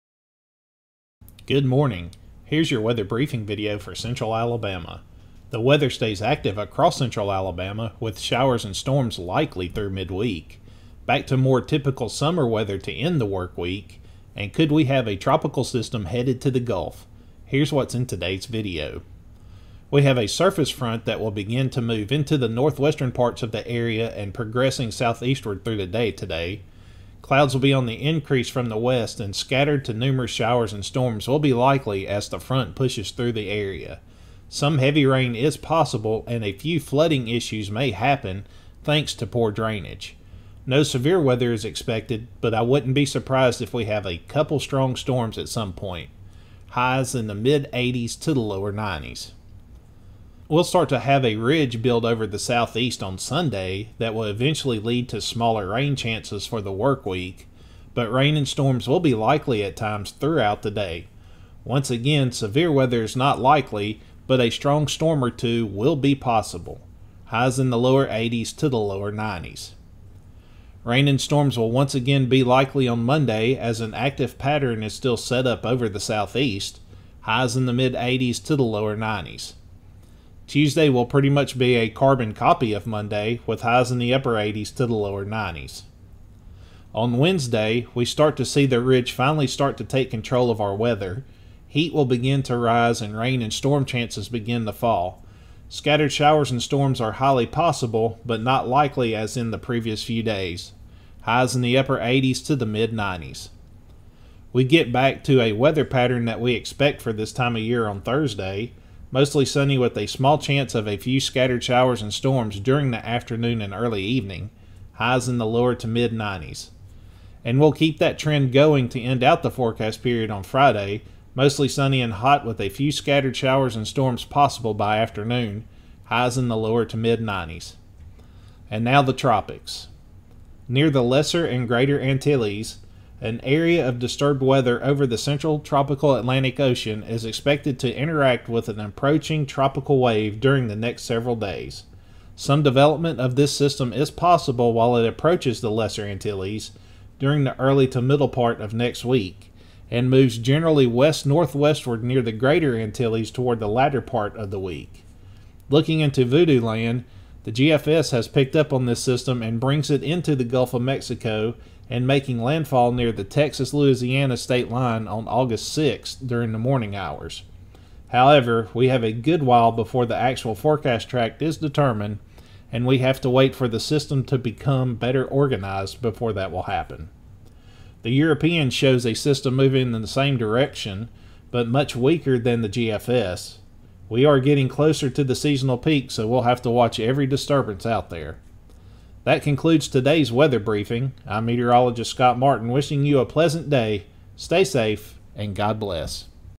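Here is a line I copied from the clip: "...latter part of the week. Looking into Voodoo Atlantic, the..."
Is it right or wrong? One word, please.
wrong.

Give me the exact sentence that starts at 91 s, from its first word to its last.
Heat will begin to rise and rain and storm chances begin to fall.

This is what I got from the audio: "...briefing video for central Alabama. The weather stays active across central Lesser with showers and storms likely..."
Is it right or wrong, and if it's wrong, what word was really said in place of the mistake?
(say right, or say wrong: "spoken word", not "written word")
wrong: "Alabama", not "Lesser".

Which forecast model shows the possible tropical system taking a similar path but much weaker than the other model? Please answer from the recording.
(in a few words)
European.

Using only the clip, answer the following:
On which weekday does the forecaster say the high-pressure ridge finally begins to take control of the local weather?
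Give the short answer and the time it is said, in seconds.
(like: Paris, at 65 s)
Wednesday, at 87 s.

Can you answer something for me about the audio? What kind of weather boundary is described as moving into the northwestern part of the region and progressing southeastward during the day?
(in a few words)
Surface front.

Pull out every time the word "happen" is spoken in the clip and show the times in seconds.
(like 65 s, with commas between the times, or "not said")
37 s, 176 s.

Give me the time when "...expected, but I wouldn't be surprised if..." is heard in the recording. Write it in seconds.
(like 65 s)
41 s.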